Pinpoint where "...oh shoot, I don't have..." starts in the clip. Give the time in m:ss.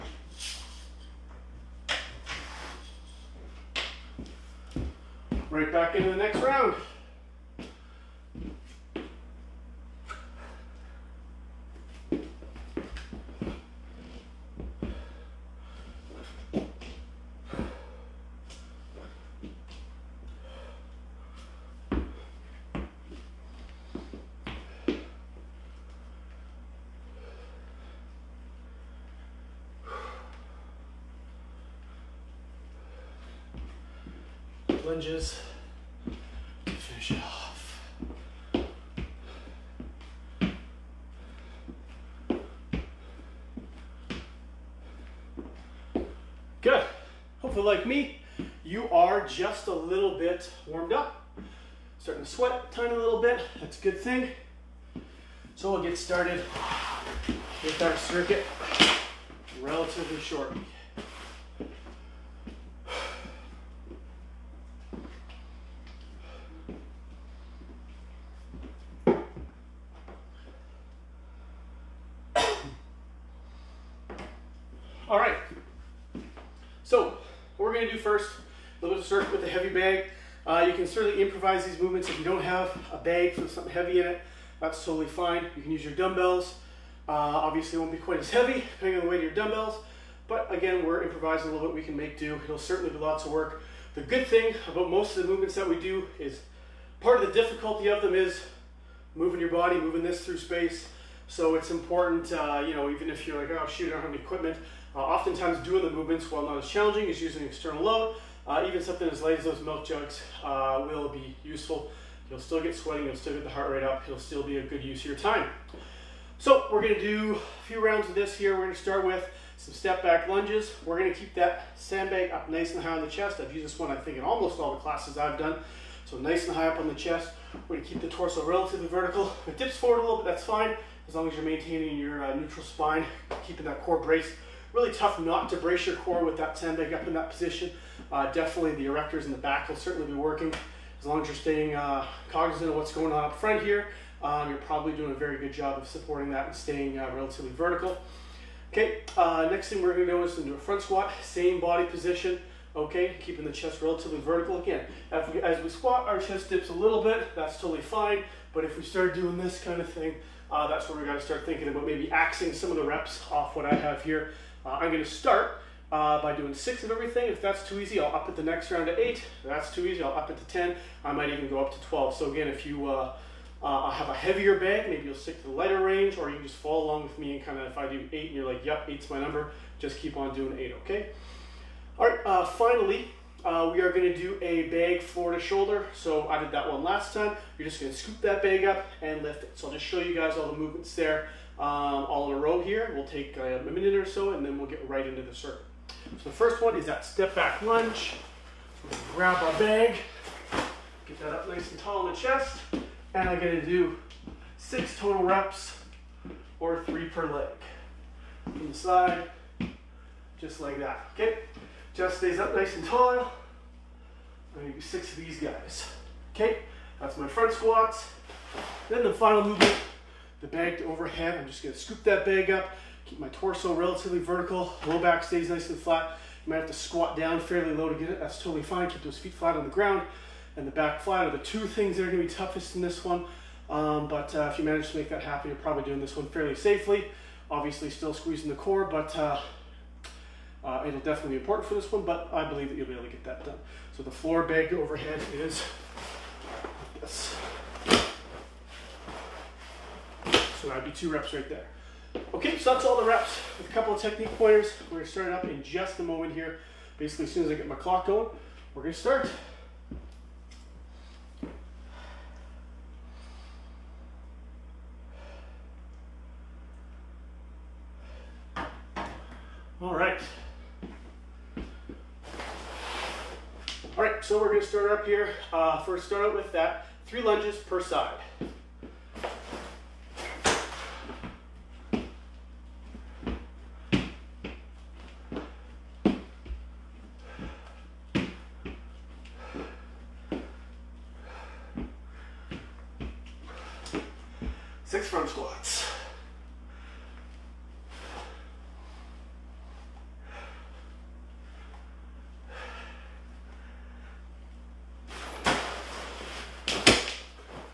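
1:43.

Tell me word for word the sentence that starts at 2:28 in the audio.
Okay, uh, next thing we're gonna do is into a front squat, same body position, okay, keeping the chest relatively vertical.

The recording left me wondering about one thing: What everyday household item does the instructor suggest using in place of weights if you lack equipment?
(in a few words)
milk jugs.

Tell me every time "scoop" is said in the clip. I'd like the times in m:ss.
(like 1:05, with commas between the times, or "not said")
3:07, 3:41.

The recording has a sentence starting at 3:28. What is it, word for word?
From the side, just like that, okay?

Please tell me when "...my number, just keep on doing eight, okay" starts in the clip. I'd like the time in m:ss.
2:59.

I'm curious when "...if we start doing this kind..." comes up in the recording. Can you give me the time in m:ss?
2:38.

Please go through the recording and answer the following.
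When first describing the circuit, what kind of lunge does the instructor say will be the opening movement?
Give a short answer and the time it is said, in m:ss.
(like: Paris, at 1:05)
step back lunges, at 1:59.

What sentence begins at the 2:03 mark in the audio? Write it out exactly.
I've used this one, I think, in almost all the classes I've done.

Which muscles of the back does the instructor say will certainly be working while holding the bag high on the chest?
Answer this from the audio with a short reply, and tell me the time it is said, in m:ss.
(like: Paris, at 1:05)
erectors, at 2:18.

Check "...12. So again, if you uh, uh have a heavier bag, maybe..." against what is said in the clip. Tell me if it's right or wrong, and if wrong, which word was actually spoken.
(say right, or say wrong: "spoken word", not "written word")
right.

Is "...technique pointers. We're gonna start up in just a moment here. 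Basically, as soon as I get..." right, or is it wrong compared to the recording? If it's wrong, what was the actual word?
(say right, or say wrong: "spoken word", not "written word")
right.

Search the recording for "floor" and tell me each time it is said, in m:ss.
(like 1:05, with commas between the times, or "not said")
3:05, 4:04.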